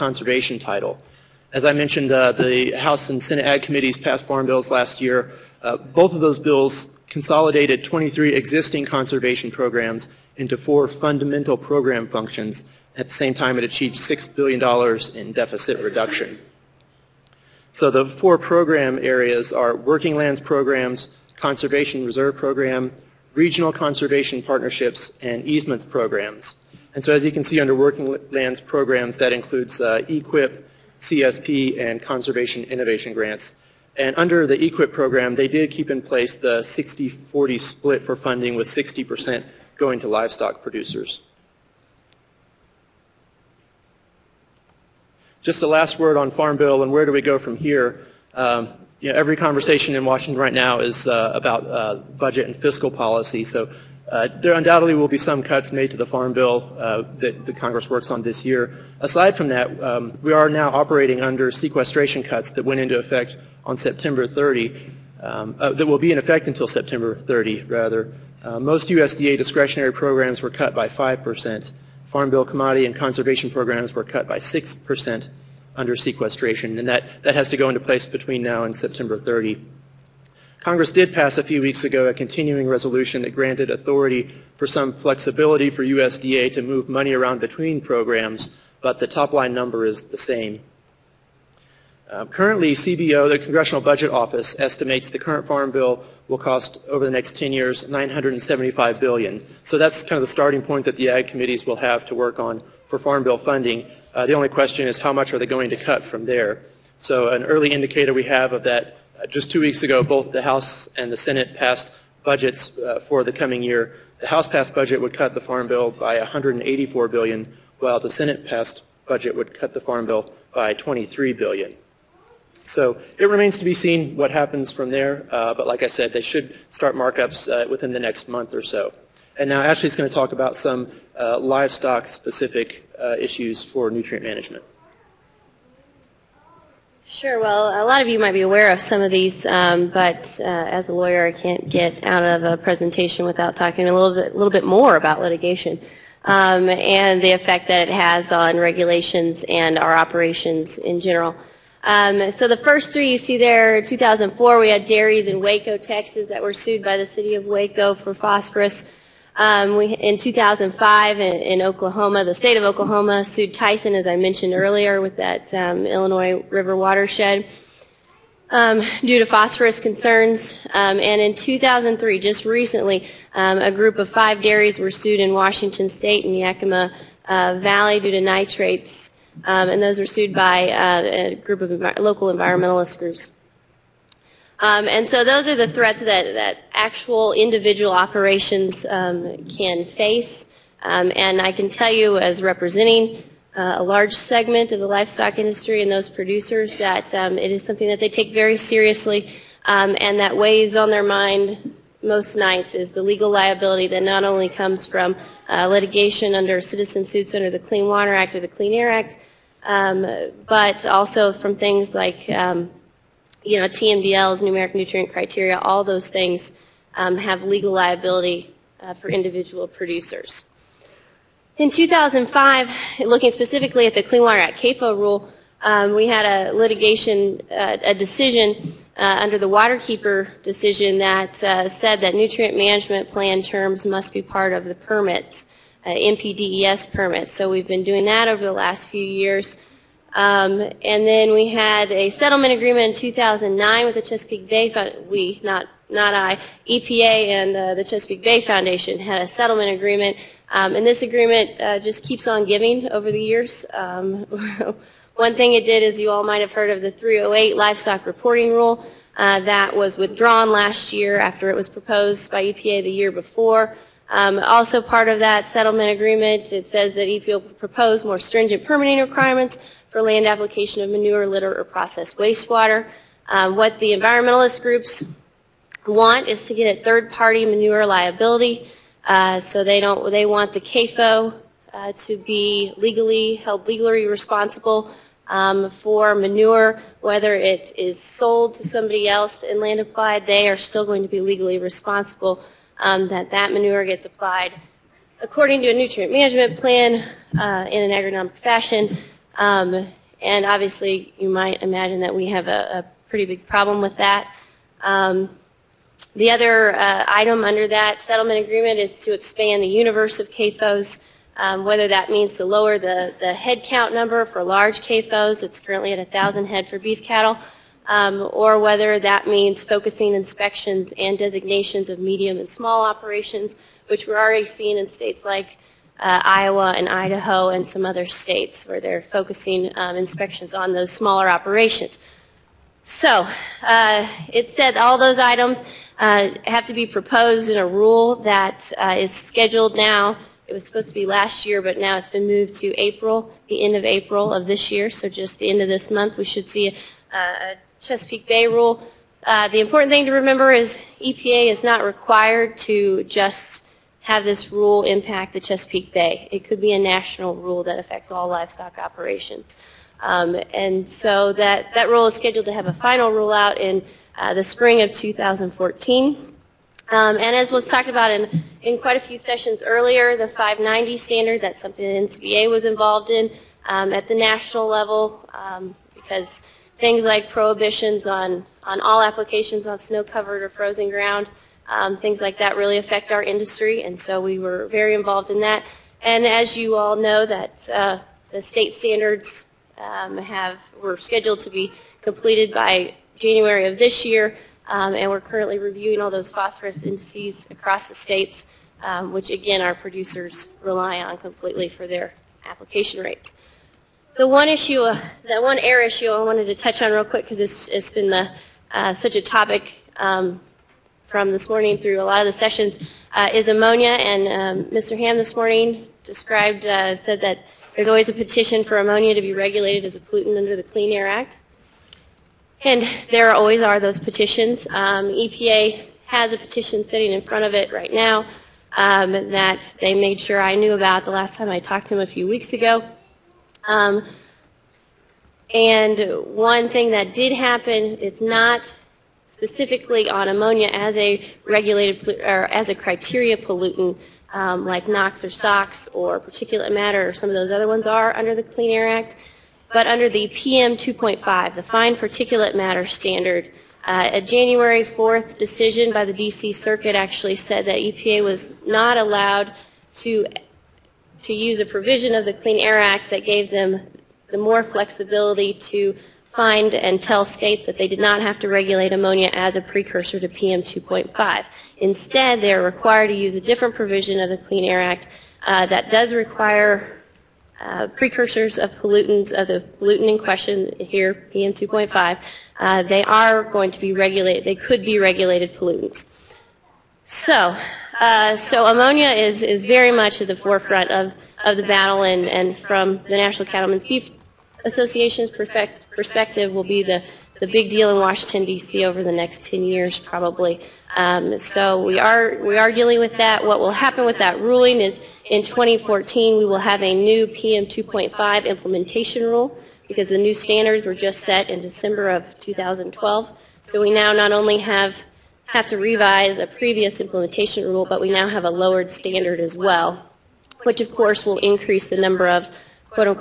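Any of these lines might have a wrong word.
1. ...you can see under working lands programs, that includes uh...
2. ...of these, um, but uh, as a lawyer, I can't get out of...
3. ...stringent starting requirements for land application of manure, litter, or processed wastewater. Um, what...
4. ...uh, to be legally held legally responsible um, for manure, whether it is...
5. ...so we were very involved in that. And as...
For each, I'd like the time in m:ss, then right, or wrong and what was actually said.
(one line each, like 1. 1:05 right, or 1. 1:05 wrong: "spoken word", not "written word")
1. 0:27 right
2. 2:18 right
3. 4:28 wrong: "permitting", not "starting"
4. 4:41 right
5. 6:23 right.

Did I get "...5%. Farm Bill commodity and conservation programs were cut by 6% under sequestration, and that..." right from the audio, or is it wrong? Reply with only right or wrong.
right.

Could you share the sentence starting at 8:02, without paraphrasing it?
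Uh, they are going to be regulated, they could be regulated pollutants.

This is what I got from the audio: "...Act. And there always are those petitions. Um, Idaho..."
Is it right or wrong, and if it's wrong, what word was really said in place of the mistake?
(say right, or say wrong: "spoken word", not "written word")
wrong: "EPA", not "Idaho".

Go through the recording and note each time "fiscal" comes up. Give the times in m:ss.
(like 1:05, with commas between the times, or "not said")
0:52.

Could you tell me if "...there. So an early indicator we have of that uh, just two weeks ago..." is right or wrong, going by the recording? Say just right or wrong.
right.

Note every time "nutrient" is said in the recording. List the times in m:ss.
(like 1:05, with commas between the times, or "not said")
2:13, 3:34, 3:52, 4:55.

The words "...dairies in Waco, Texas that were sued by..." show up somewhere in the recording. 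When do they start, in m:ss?
2:34.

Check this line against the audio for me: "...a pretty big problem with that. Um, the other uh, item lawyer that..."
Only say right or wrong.
wrong.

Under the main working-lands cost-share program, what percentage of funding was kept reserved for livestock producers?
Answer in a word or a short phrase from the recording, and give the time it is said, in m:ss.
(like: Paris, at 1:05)
60%, at 0:38.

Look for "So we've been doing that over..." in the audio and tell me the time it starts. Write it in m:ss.
3:57.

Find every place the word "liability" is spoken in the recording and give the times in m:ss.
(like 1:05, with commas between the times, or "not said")
3:23, 3:37, 4:37.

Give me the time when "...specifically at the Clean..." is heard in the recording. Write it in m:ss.
3:43.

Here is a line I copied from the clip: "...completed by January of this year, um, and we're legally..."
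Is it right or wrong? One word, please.
wrong.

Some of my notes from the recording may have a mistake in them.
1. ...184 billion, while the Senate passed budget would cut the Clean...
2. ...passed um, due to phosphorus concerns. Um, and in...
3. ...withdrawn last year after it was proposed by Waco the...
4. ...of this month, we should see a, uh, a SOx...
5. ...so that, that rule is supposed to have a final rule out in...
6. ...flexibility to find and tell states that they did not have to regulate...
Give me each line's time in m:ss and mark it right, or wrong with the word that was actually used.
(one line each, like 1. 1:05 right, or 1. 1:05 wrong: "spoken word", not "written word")
1. 1:56 wrong: "Farm", not "Clean"
2. 2:46 wrong: "watershed", not "passed"
3. 4:19 wrong: "EPA", not "Waco"
4. 5:45 wrong: "Chesapeake", not "SOx"
5. 6:00 wrong: "scheduled", not "supposed"
6. 7:44 right.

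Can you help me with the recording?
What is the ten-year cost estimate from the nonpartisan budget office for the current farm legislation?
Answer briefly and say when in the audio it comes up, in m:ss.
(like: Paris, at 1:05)
$975 billion, at 1:37.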